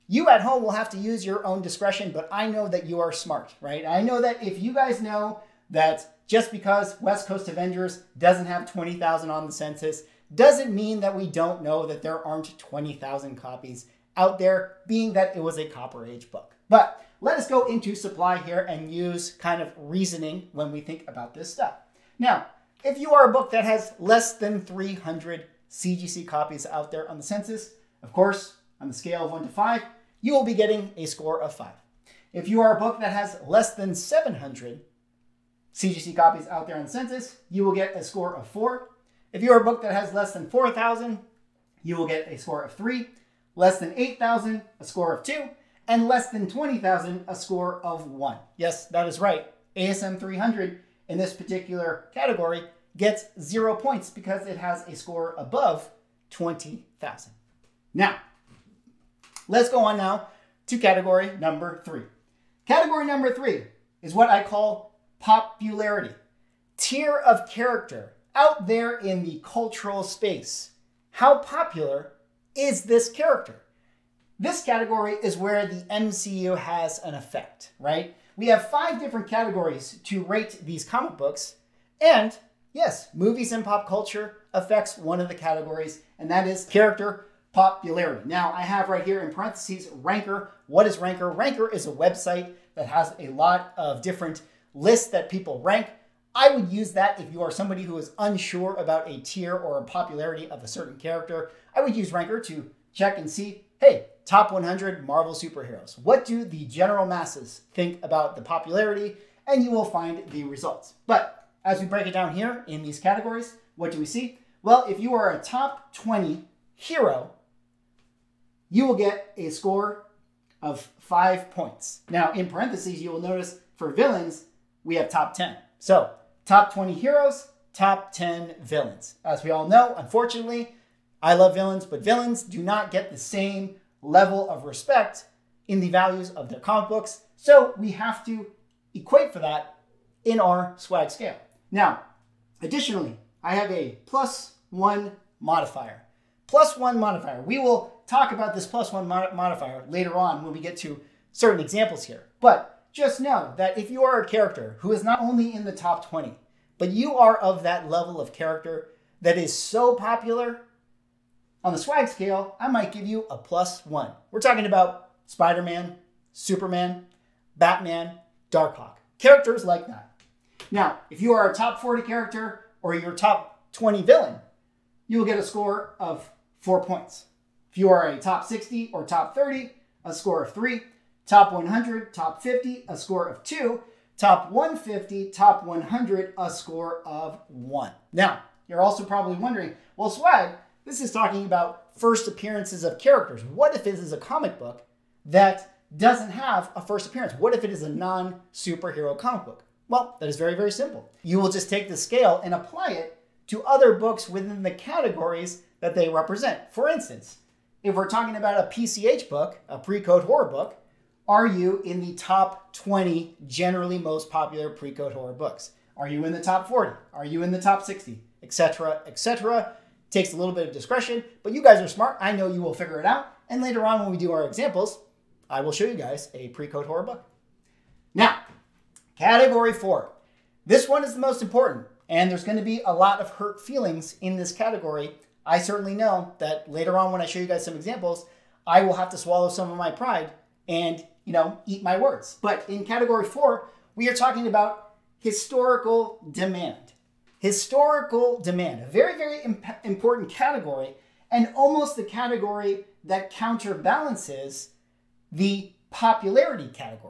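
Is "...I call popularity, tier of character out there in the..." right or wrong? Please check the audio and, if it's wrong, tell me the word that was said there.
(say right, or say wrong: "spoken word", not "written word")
right.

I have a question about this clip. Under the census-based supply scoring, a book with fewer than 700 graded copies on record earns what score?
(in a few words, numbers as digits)
4.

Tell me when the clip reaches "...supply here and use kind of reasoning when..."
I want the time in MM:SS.
00:17.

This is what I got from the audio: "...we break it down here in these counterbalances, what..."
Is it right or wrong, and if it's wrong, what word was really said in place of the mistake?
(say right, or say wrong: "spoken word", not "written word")
wrong: "categories", not "counterbalances".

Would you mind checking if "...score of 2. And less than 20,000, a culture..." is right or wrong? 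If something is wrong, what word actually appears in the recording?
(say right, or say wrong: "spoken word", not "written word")
wrong: "score", not "culture".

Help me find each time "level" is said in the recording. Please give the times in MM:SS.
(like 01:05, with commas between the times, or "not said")
02:13, 02:37.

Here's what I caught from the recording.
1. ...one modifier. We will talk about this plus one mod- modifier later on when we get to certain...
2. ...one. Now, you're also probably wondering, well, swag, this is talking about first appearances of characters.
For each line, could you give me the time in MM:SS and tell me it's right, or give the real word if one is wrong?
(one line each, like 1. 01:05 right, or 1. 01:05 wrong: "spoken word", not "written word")
1. 02:26 right
2. 03:07 right.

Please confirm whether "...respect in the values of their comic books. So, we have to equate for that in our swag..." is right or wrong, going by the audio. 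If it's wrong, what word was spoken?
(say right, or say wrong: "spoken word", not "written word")
right.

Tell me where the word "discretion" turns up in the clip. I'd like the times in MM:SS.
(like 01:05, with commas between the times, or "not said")
00:01, 03:40.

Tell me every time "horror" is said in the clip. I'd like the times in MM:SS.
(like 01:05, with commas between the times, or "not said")
03:30, 03:35, 03:46.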